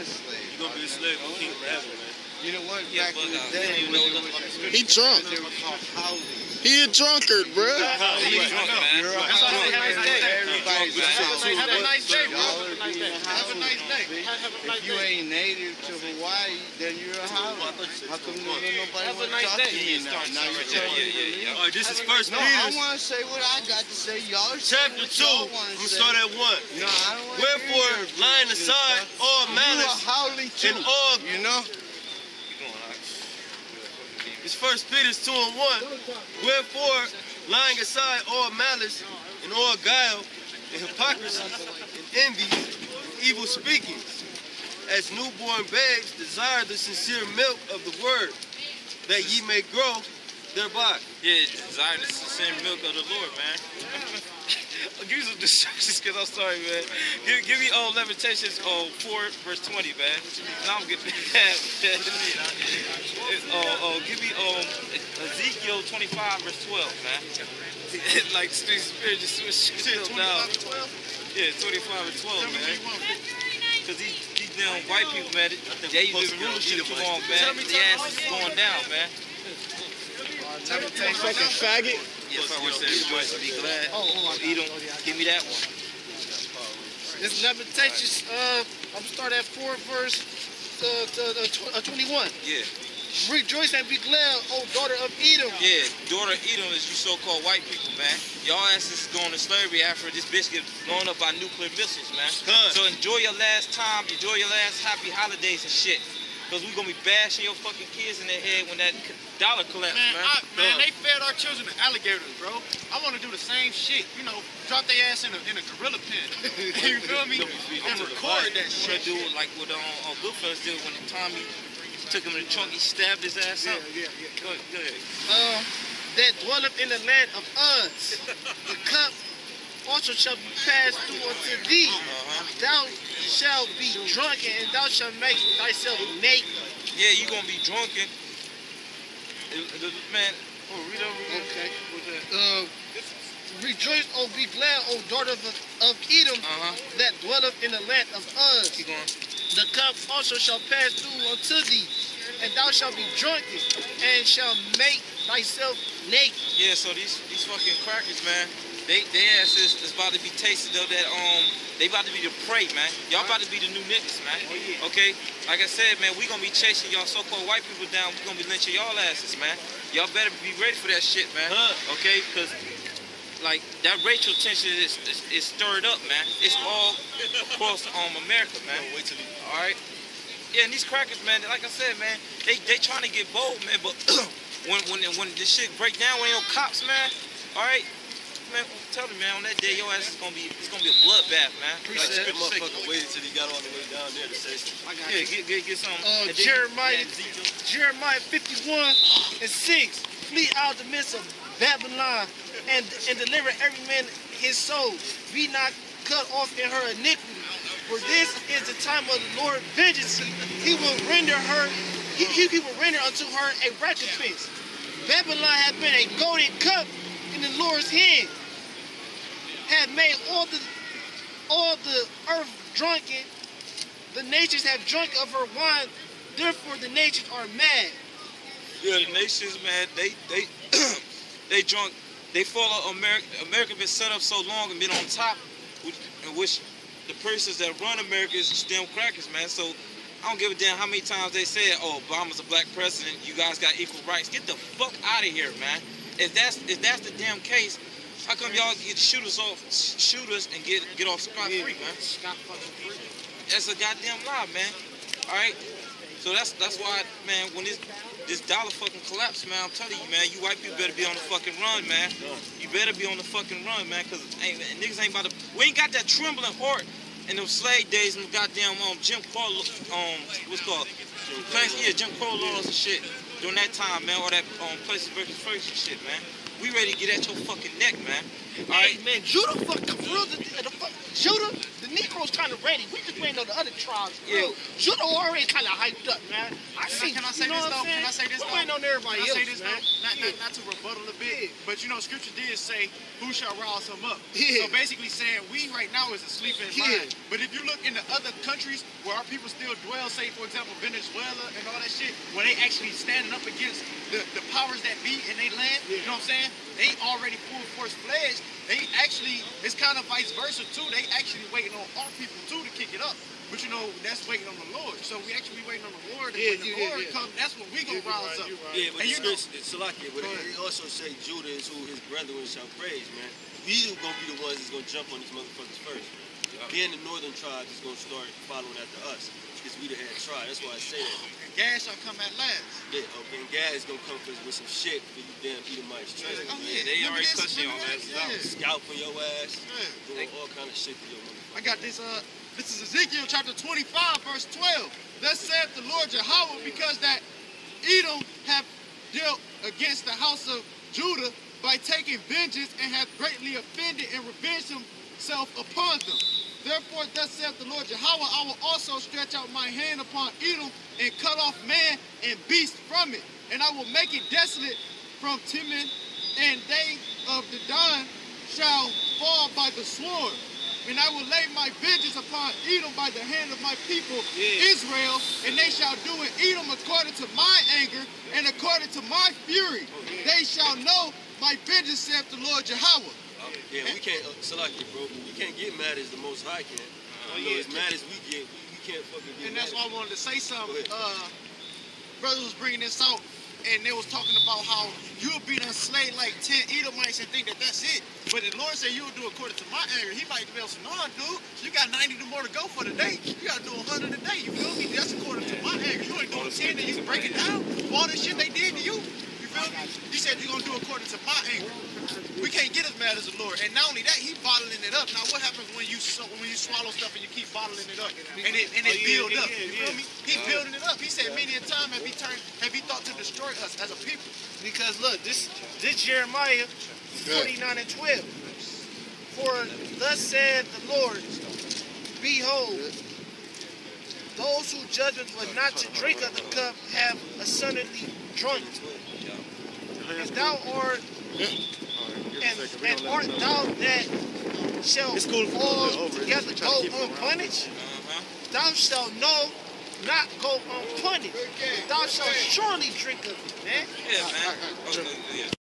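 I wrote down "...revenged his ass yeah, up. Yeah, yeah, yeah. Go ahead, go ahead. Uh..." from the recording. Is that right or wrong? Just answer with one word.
wrong.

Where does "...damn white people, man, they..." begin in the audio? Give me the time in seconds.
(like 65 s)
74 s.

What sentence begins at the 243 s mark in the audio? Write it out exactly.
You guys got equal rights." Get the fuck out of here, man.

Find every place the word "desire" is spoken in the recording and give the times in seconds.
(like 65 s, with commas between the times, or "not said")
46 s, 51 s.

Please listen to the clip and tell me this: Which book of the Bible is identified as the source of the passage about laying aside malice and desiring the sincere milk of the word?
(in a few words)
First Peter.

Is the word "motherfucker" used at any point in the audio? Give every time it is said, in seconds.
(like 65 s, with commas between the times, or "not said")
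192 s, 325 s, 341 s.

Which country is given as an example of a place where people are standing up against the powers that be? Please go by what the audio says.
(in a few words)
Venezuela.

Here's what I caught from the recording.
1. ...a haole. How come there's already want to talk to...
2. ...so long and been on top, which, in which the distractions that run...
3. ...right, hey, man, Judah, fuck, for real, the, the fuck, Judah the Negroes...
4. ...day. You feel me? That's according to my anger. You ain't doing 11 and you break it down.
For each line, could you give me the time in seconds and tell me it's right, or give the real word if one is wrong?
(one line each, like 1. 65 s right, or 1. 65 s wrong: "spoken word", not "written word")
1. 17 s wrong: "nobody", not "already"
2. 234 s wrong: "persons", not "distractions"
3. 278 s right
4. 404 s wrong: "10", not "11".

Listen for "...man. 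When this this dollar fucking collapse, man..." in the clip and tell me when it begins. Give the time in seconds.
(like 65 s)
257 s.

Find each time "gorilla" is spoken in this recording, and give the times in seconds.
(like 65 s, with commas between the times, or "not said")
115 s.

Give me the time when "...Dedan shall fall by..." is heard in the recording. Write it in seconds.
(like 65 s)
367 s.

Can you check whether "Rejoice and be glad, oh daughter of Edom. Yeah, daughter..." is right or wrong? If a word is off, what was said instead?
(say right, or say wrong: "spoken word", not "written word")
right.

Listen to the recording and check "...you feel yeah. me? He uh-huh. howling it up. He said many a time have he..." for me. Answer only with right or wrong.
wrong.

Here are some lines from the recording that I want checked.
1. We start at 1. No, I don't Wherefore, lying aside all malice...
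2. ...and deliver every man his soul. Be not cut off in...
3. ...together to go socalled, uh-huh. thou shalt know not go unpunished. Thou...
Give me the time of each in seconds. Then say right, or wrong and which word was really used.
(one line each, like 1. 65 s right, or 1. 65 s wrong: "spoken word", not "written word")
1. 25 s right
2. 203 s right
3. 446 s wrong: "unpunished", not "socalled".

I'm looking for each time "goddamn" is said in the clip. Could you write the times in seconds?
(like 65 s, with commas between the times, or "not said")
253 s, 268 s.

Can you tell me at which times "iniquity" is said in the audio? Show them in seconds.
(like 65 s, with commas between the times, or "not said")
206 s.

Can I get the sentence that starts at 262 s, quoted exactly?
You better be on the fucking run, man, cause niggas ain't about to.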